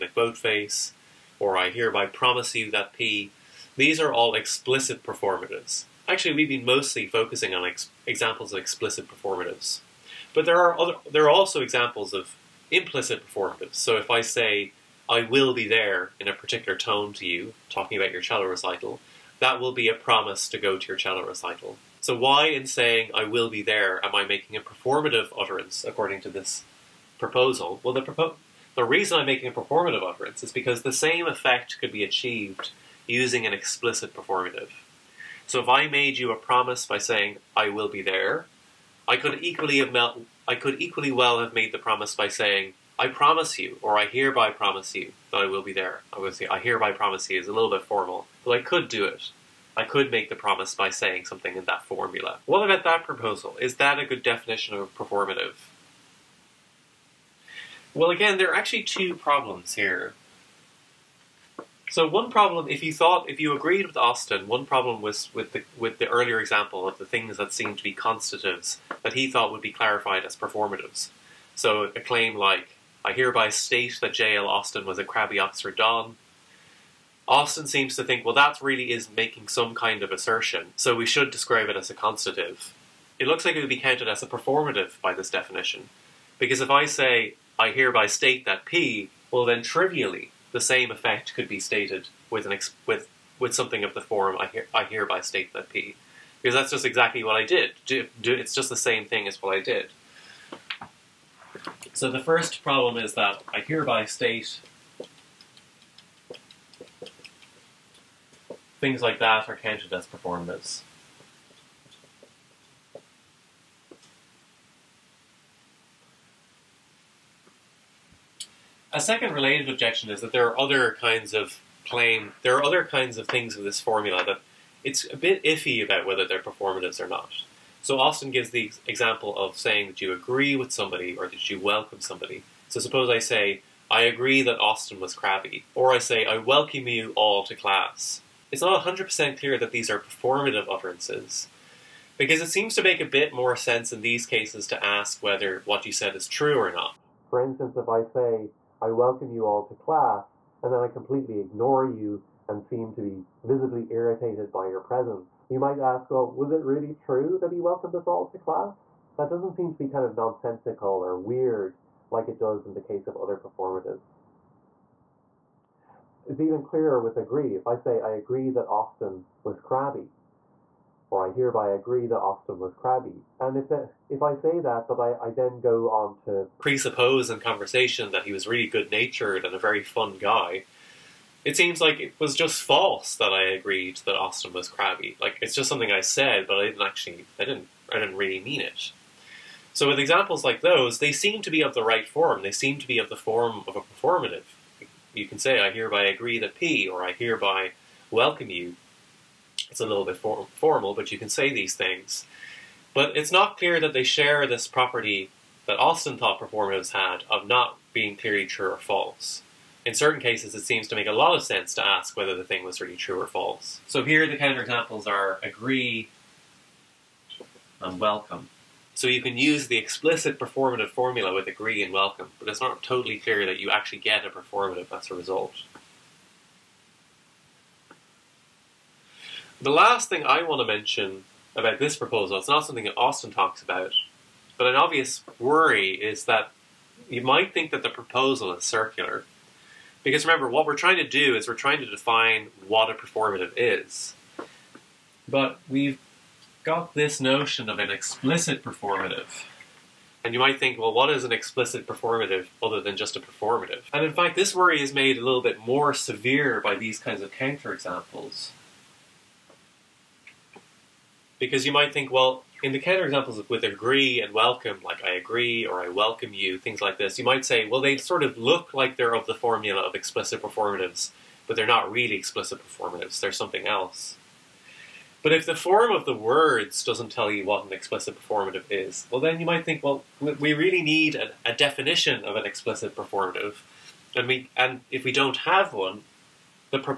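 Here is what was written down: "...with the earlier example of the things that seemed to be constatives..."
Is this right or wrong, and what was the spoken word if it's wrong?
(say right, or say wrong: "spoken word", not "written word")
right.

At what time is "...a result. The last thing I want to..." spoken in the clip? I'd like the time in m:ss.
3:45.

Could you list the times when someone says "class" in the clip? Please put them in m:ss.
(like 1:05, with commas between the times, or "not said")
2:17, 2:29, 2:38.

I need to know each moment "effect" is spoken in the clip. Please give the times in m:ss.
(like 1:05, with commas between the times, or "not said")
0:31, 1:30.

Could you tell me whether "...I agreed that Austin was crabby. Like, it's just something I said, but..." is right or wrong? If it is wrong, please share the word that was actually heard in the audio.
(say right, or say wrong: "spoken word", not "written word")
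right.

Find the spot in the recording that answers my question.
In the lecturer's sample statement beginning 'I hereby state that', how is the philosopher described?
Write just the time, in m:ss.
1:15.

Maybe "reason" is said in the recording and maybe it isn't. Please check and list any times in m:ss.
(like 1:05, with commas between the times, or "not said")
0:28.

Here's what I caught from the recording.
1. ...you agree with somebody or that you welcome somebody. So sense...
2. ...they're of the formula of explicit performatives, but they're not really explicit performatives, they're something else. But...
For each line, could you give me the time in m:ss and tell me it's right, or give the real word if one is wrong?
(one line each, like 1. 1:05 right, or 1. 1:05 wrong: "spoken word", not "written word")
1. 2:10 wrong: "suppose", not "sense"
2. 4:28 right.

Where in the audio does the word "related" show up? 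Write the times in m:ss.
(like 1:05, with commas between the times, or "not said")
1:59.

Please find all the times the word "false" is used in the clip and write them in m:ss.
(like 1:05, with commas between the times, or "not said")
3:02, 3:28, 3:33.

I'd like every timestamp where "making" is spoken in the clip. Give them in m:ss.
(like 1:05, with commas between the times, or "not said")
0:24, 0:29, 1:19.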